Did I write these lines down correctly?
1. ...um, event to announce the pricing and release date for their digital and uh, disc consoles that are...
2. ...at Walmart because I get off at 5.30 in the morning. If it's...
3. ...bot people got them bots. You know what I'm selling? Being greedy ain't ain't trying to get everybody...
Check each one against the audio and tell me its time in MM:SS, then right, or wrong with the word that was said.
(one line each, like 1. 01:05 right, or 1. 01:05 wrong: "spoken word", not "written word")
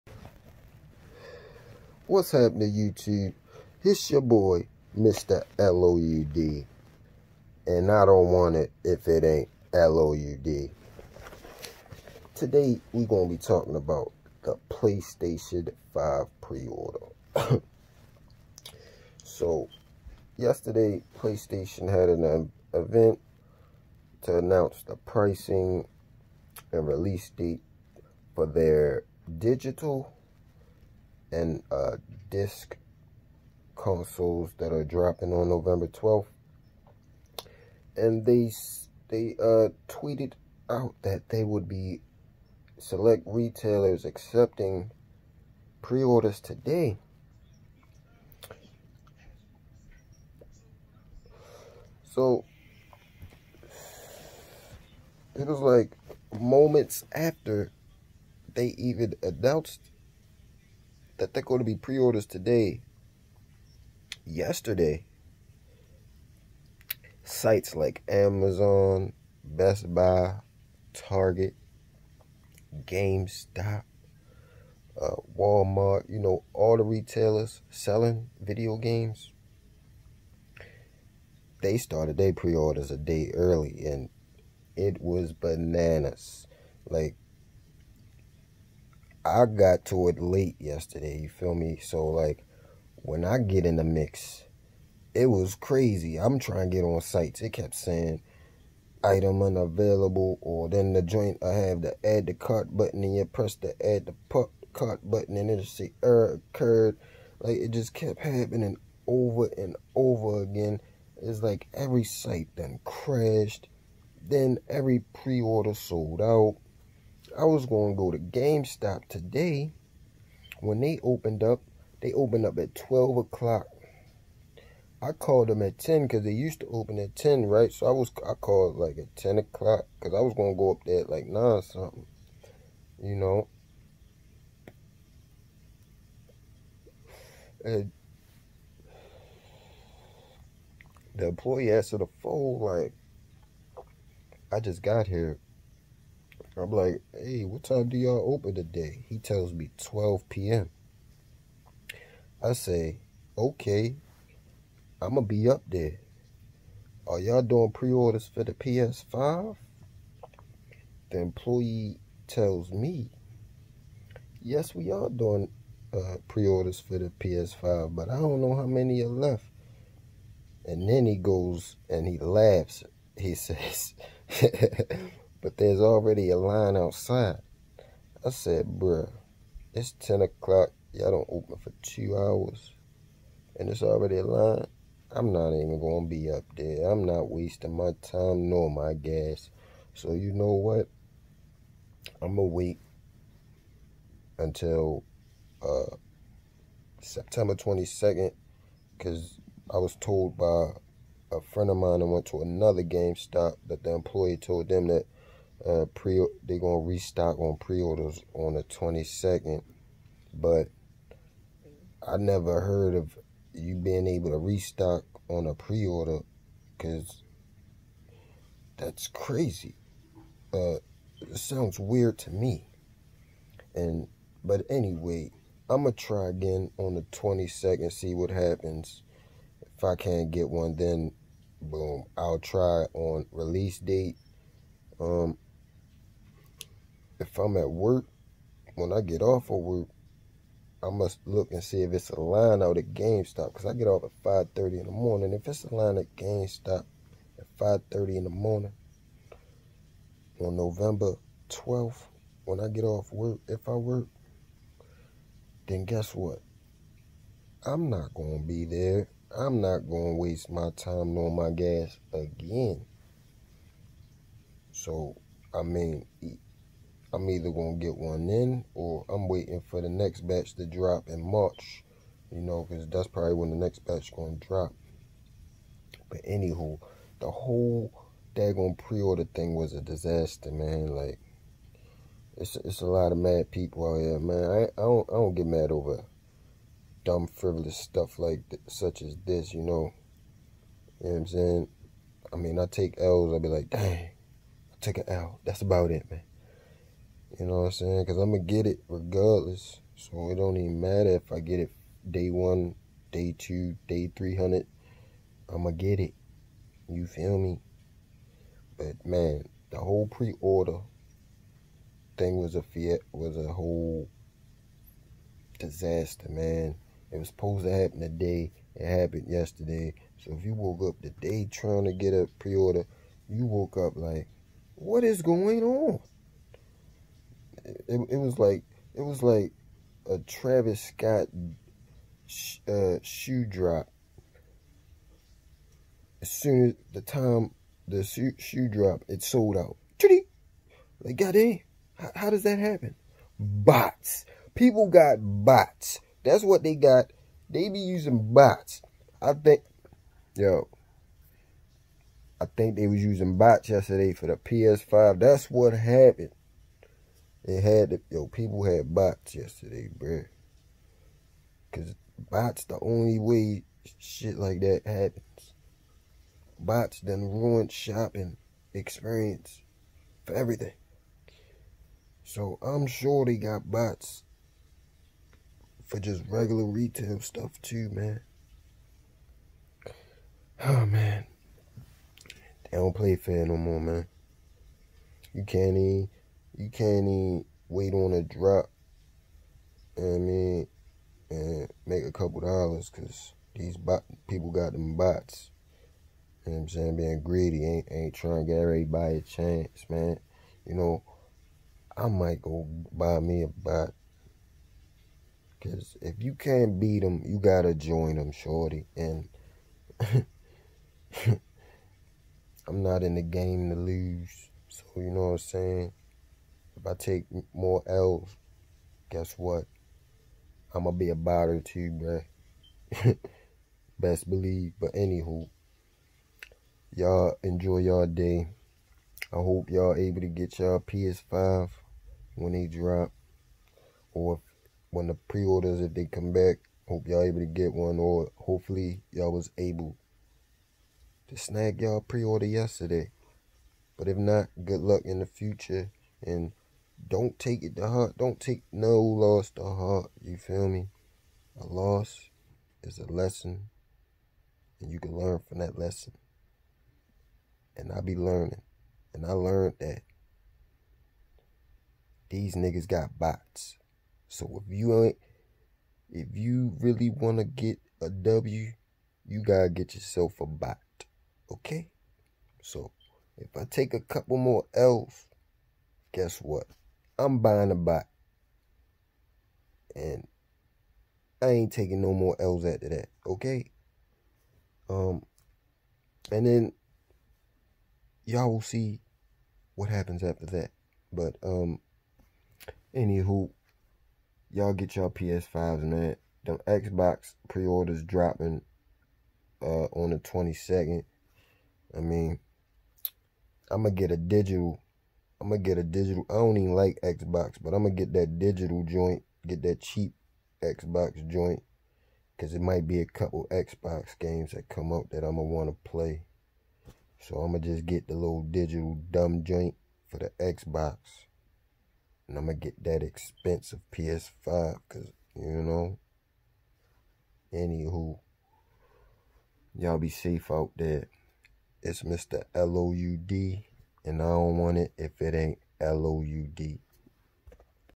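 1. 00:22 right
2. 04:02 wrong: "GameStop", not "Walmart"
3. 06:33 wrong: "saying", not "selling".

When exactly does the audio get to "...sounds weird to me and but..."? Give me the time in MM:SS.
03:41.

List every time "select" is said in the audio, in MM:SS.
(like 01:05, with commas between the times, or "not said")
00:42.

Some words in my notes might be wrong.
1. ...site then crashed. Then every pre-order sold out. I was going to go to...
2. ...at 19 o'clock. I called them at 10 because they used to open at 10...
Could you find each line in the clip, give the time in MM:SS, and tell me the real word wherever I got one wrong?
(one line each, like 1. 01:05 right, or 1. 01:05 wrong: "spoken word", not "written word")
1. 01:52 right
2. 02:02 wrong: "12", not "19".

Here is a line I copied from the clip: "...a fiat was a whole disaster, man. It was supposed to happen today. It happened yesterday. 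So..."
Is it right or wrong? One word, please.
right.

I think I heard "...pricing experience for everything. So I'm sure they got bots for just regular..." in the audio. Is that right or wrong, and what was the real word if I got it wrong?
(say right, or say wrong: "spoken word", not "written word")
wrong: "shopping", not "pricing".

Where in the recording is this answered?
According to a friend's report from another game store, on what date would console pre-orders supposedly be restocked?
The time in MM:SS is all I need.
03:17.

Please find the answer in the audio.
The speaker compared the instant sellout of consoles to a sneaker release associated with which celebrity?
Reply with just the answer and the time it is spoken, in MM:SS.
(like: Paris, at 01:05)
Travis Scott, at 05:30.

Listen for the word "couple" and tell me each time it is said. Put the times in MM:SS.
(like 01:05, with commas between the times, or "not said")
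06:32, 07:53, 08:33.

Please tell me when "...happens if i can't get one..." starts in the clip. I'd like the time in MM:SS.
03:48.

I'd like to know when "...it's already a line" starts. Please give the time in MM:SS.
03:03.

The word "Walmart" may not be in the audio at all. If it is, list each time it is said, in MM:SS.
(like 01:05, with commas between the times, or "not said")
01:15.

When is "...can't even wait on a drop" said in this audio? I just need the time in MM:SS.
06:26.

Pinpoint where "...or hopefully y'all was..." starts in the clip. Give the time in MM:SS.
07:17.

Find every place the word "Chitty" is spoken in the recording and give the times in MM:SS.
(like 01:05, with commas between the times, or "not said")
05:39.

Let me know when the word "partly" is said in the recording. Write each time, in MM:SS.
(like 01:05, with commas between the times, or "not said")
not said.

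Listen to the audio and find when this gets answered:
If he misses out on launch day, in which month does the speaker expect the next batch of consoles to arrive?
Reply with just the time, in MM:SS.
04:31.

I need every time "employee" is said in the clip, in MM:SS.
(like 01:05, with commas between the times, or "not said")
02:21, 02:41, 03:23.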